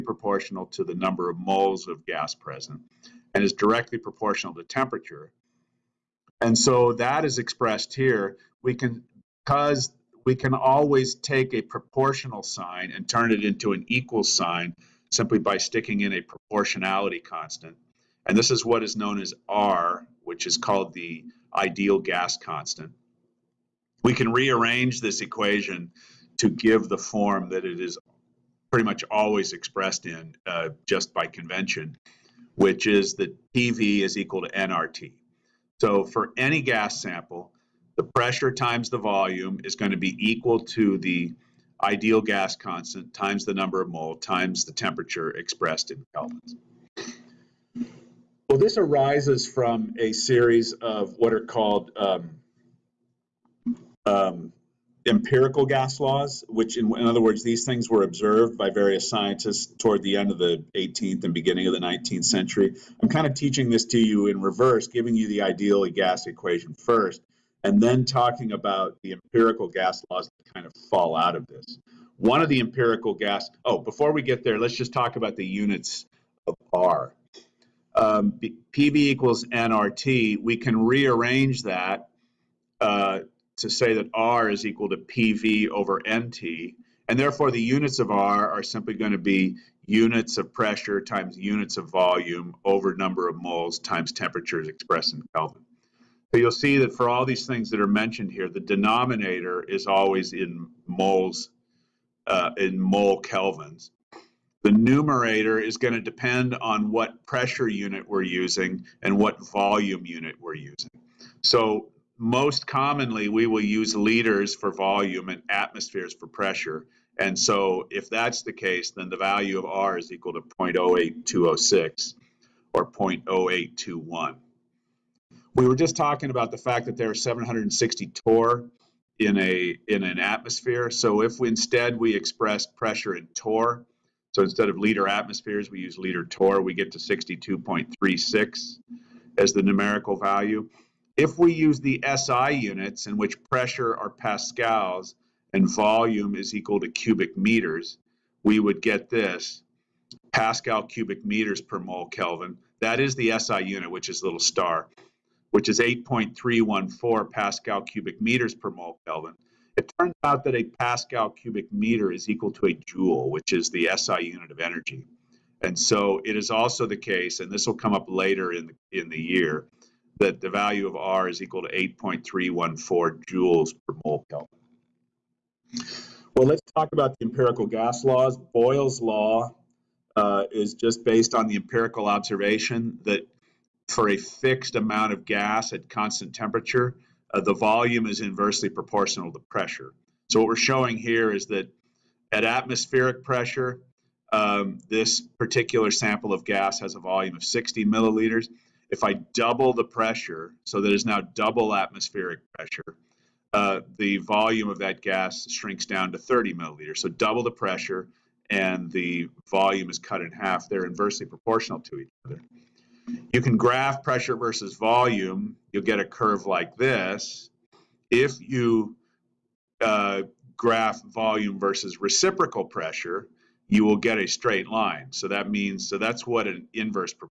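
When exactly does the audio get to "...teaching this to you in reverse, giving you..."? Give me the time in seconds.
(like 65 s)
63 s.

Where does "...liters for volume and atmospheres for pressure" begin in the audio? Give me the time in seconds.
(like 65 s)
113 s.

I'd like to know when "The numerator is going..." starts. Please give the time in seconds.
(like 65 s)
104 s.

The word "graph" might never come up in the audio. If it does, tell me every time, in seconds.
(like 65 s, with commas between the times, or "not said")
213 s, 220 s.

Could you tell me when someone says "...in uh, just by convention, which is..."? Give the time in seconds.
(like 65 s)
30 s.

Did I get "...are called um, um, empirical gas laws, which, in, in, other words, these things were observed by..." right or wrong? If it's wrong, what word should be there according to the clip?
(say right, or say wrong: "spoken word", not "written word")
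right.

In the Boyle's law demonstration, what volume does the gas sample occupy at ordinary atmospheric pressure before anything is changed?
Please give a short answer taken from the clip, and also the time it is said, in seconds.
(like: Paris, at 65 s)
60 milliliters, at 197 s.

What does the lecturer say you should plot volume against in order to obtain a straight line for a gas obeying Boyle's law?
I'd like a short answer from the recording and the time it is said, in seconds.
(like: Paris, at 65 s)
reciprocal pressure, at 221 s.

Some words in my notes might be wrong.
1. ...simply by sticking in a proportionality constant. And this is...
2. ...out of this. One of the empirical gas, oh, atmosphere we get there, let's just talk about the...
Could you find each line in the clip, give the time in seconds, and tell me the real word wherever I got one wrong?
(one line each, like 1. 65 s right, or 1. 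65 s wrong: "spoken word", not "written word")
1. 15 s right
2. 71 s wrong: "before", not "atmosphere".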